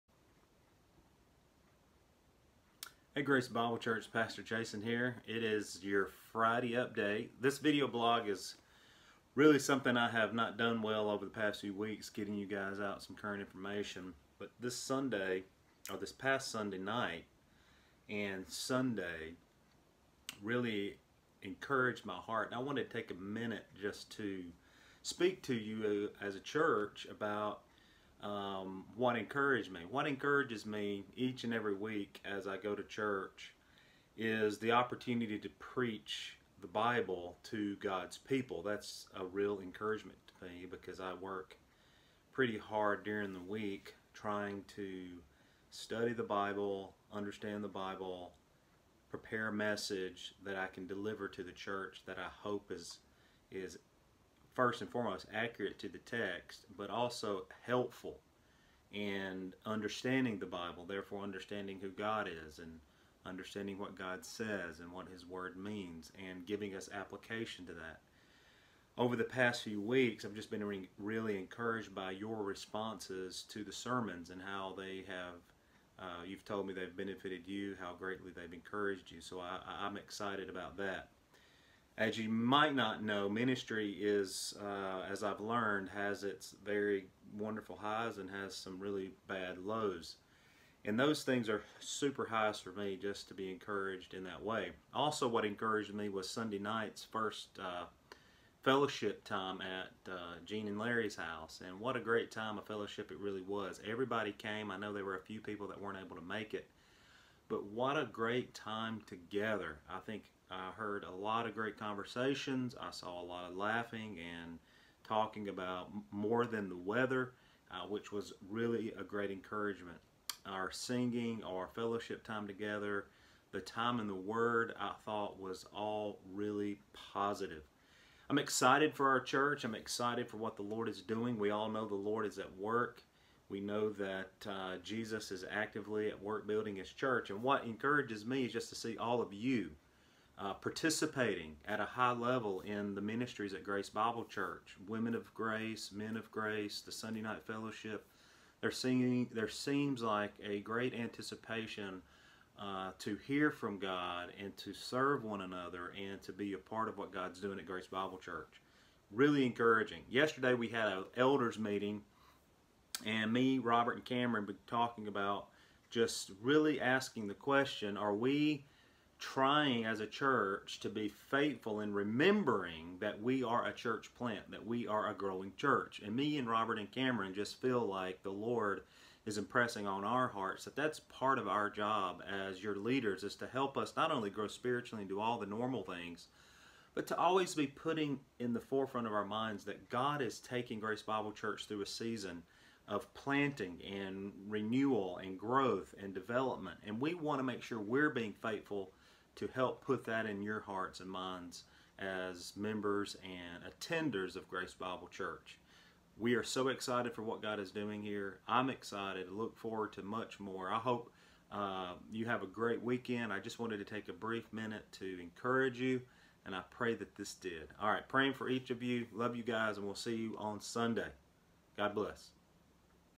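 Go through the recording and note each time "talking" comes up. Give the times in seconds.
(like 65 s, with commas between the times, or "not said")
115 s, 164 s.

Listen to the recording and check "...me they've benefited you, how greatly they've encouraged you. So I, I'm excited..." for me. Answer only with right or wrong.
right.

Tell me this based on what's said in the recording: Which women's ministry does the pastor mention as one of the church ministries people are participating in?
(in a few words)
Women of Grace.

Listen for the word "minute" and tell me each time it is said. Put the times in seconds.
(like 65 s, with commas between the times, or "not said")
23 s, 214 s.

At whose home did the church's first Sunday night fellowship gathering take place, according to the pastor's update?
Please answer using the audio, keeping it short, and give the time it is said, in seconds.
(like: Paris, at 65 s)
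Gene and Larry's house, at 100 s.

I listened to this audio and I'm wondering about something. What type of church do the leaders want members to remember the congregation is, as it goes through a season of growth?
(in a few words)
A church plant.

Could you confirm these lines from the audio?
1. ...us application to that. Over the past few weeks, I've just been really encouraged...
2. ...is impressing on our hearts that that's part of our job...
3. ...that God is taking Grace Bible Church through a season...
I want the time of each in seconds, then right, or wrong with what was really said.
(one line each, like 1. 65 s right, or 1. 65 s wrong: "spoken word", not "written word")
1. 66 s right
2. 179 s right
3. 189 s right.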